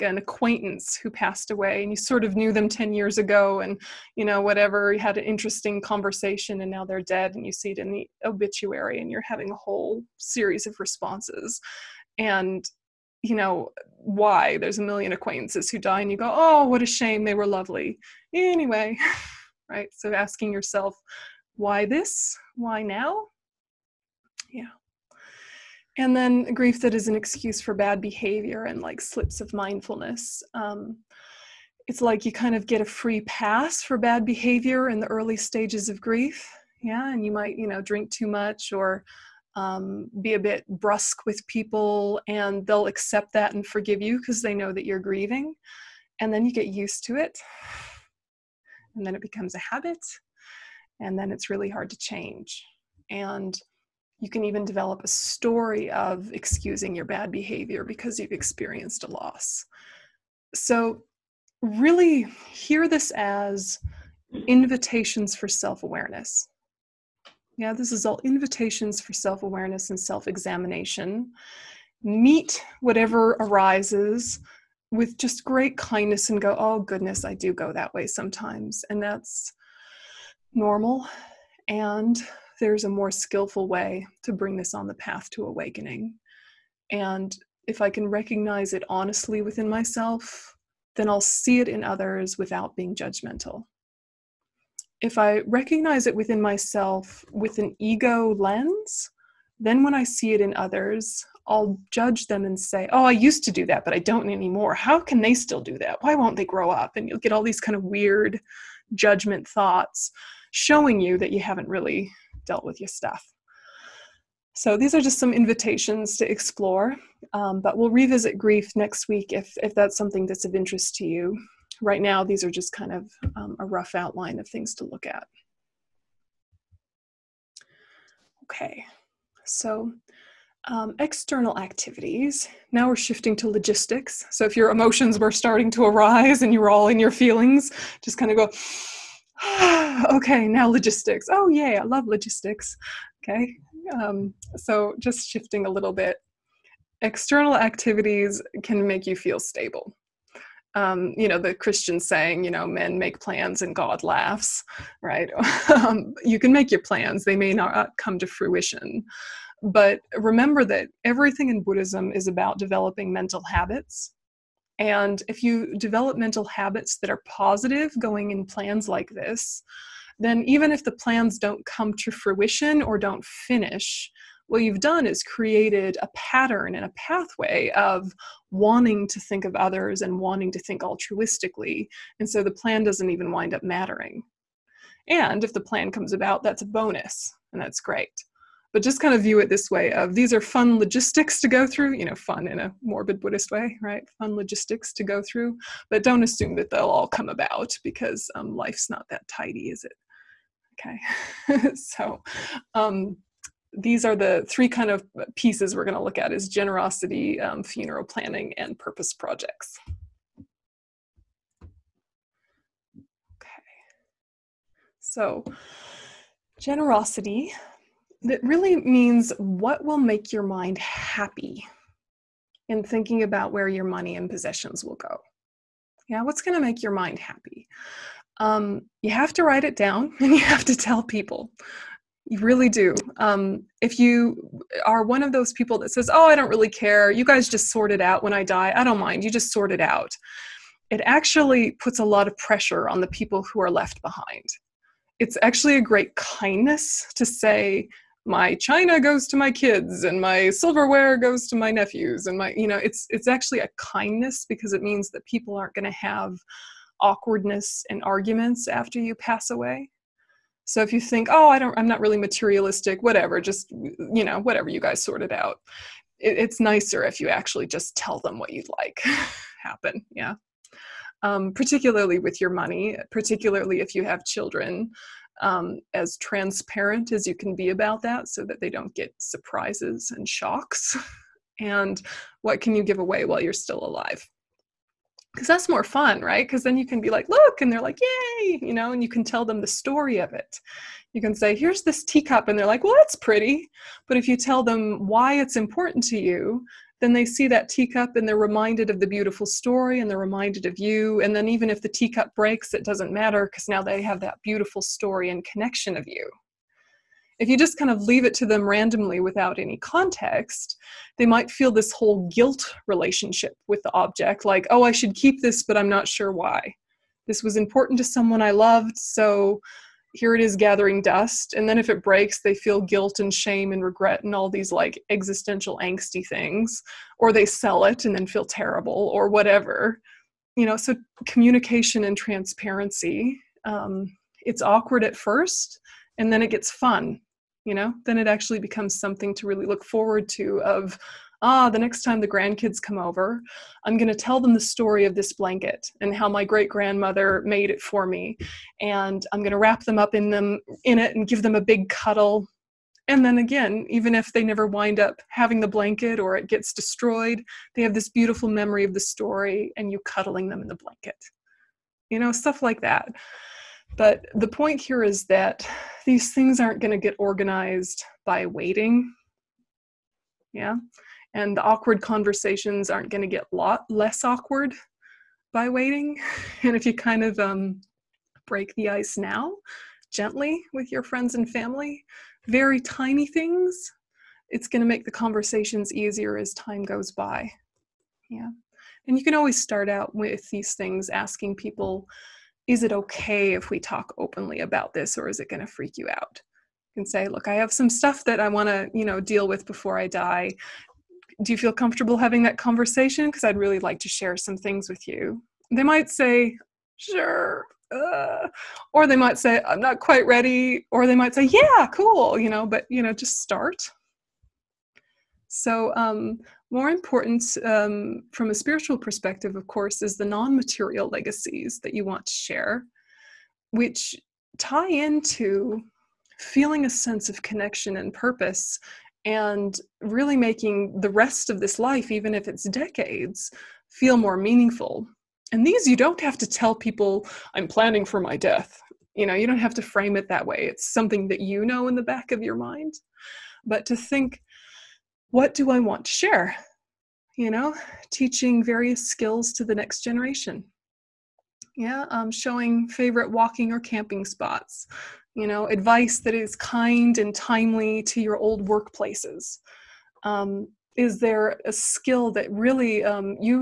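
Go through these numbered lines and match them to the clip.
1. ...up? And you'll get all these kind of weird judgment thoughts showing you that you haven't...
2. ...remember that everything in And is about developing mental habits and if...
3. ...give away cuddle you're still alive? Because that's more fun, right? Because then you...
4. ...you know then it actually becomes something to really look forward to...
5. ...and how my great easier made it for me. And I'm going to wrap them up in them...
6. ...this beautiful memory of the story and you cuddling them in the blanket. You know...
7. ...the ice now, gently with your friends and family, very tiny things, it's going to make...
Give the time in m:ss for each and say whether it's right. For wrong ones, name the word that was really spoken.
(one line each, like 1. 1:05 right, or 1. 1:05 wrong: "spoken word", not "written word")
1. 1:46 right
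2. 2:40 wrong: "Buddhism", not "And"
3. 4:42 wrong: "while", not "cuddle"
4. 5:37 right
5. 5:45 wrong: "grandmother", not "easier"
6. 5:57 right
7. 6:18 right.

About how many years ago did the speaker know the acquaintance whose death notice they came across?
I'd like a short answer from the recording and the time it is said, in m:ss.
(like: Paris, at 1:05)
10 years, at 0:02.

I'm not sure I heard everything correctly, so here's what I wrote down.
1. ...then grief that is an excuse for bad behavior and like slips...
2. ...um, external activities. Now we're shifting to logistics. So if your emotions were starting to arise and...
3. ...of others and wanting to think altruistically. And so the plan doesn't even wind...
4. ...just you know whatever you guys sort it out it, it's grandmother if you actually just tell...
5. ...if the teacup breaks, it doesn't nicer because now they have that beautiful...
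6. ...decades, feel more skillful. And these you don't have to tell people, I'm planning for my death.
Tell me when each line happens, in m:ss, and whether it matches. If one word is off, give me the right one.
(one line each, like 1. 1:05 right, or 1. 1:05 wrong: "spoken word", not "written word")
1. 0:26 right
2. 2:10 right
3. 2:59 right
4. 4:23 wrong: "nicer", not "grandmother"
5. 5:01 wrong: "matter", not "nicer"
6. 7:12 wrong: "meaningful", not "skillful".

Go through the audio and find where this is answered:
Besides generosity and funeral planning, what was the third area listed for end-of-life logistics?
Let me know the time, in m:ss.
3:28.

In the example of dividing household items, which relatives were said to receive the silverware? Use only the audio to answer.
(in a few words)
Nephews.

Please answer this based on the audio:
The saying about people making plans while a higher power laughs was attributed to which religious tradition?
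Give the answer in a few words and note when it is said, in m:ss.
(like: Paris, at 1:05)
Christian, at 2:31.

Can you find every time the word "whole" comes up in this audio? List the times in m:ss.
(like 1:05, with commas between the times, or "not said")
0:09, 5:11.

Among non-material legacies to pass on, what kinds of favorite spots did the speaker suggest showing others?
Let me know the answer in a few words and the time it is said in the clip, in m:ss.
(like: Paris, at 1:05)
Walking or camping spots, at 7:33.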